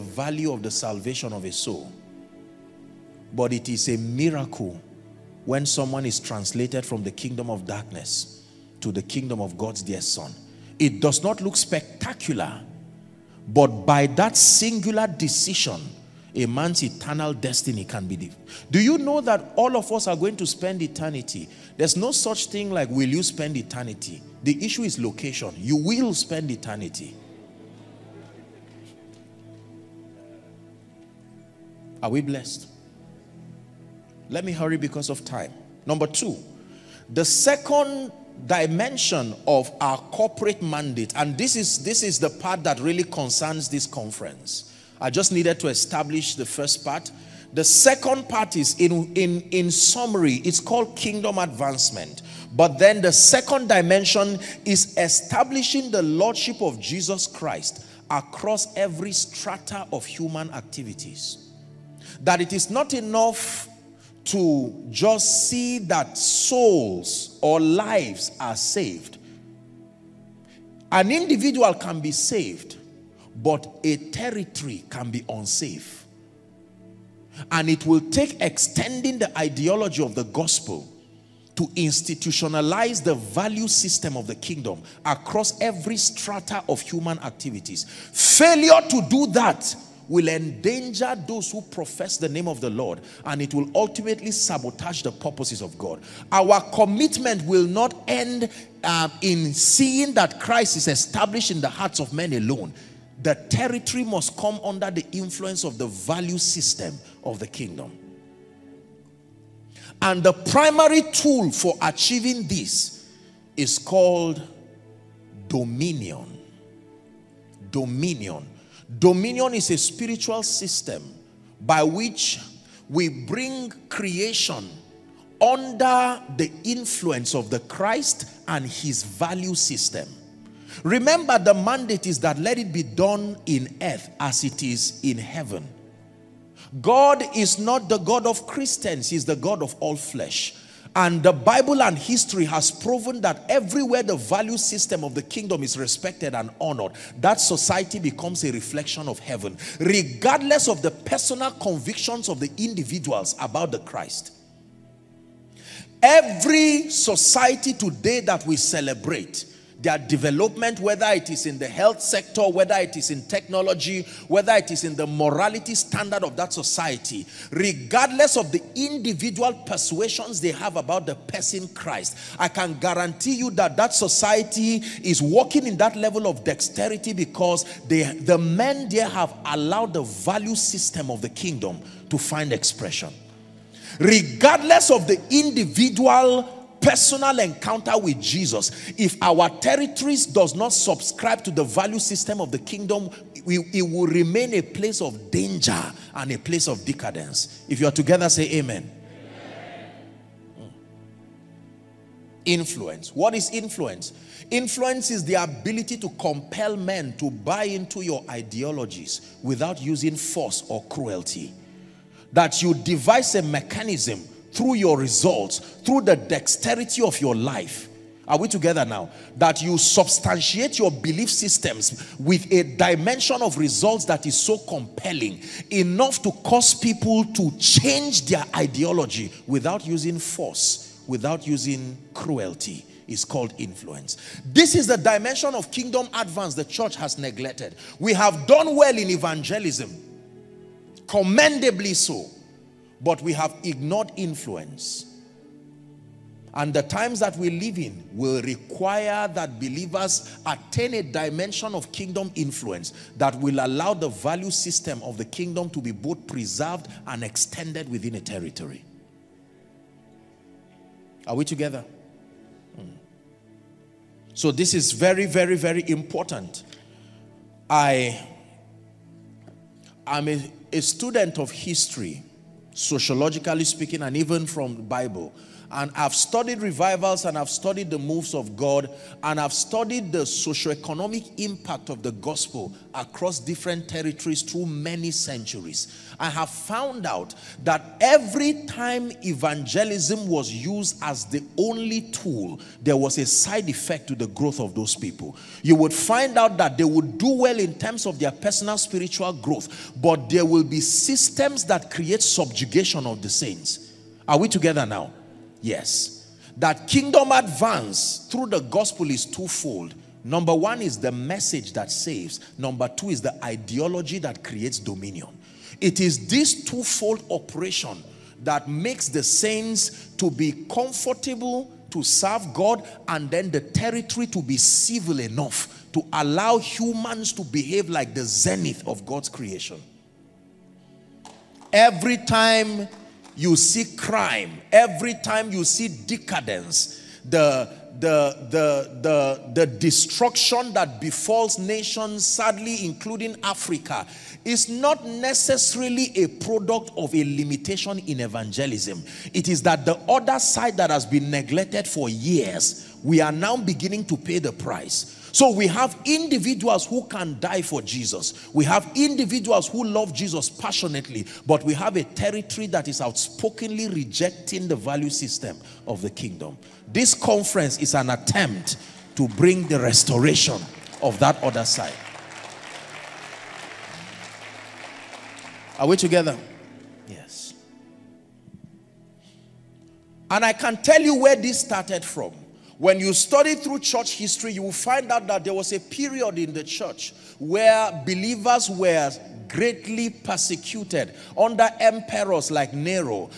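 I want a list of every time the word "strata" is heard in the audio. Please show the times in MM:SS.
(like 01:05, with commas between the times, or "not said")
00:59, 01:25.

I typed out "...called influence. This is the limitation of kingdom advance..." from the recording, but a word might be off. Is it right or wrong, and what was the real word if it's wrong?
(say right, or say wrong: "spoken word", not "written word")
wrong: "dimension", not "limitation".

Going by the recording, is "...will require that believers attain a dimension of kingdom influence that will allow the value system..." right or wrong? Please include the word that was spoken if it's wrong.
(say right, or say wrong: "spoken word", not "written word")
right.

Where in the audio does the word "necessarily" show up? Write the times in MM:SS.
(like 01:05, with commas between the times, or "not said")
05:45.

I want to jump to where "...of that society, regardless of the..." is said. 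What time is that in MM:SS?
02:46.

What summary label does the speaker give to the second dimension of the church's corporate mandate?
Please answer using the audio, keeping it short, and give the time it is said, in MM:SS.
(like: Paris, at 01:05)
Kingdom advancement, at 00:50.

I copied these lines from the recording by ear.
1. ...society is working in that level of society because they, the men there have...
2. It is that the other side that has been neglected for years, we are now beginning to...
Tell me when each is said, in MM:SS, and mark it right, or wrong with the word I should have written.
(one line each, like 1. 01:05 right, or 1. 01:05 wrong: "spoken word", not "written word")
1. 02:53 wrong: "dexterity", not "society"
2. 05:49 right.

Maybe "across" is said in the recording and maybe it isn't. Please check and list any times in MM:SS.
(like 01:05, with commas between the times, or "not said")
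00:58, 01:25, 04:42.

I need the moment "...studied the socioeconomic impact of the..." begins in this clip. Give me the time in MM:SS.
04:39.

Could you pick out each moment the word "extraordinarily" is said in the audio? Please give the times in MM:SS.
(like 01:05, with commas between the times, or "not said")
not said.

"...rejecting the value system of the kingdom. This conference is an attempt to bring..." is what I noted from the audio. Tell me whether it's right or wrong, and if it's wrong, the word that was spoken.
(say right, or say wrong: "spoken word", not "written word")
right.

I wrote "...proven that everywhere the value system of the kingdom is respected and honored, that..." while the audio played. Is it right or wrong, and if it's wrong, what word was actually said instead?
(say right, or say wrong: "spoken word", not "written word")
right.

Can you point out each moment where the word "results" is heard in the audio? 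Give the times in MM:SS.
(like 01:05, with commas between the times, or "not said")
03:34, 03:43.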